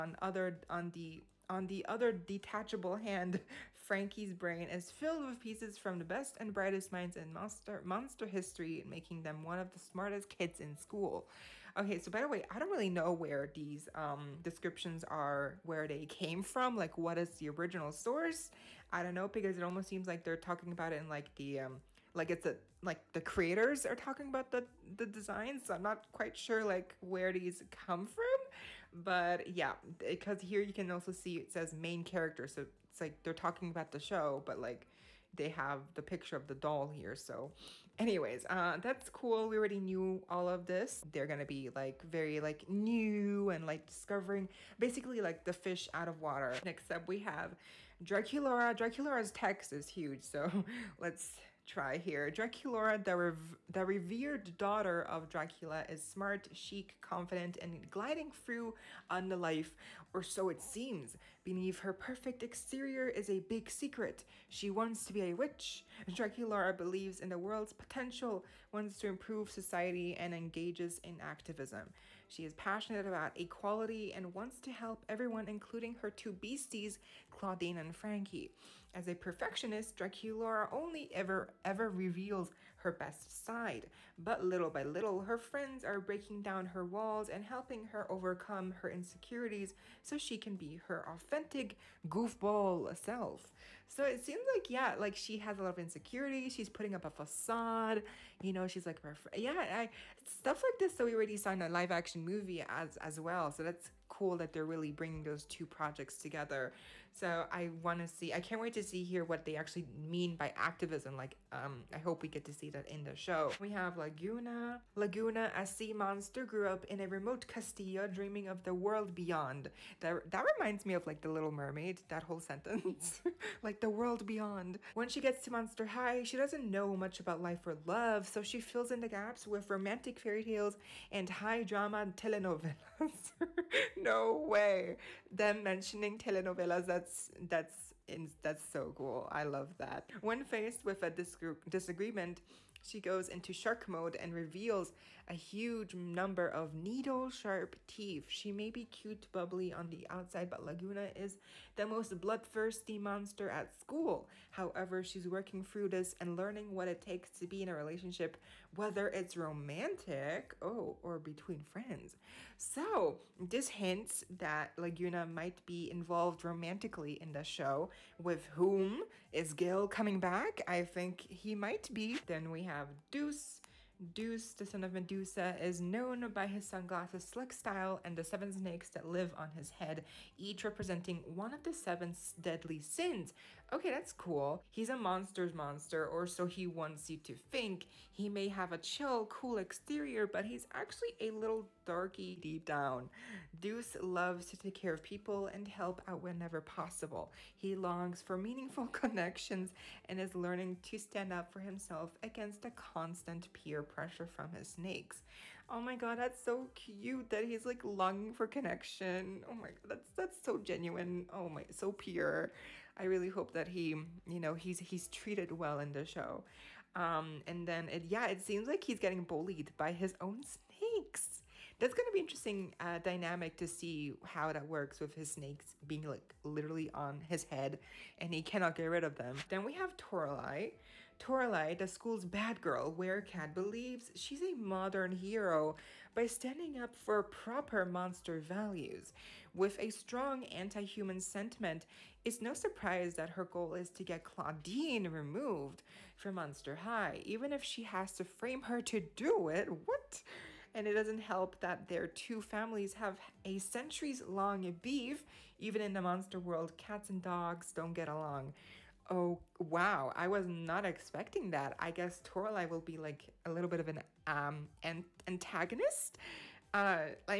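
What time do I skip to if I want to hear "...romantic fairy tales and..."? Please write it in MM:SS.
02:09.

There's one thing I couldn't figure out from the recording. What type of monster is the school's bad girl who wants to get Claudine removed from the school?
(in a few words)
Werecat.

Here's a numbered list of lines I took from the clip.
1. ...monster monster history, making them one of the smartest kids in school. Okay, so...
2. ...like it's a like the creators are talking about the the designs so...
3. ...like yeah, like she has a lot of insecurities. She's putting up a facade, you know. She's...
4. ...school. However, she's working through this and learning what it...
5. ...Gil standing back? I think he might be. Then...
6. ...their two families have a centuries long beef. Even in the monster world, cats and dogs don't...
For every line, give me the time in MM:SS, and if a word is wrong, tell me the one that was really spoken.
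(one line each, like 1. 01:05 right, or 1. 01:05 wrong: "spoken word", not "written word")
1. 00:07 right
2. 00:22 right
3. 01:34 right
4. 02:33 right
5. 02:49 wrong: "coming", not "standing"
6. 04:11 right.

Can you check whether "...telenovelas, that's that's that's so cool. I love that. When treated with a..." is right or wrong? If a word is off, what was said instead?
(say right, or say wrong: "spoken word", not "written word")
wrong: "faced", not "treated".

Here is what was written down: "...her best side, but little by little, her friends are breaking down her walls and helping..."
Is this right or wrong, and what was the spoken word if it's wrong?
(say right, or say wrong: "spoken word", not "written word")
right.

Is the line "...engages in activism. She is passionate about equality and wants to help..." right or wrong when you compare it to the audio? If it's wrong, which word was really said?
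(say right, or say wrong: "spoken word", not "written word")
right.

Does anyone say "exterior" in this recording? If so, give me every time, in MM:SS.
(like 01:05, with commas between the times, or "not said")
01:02, 03:09.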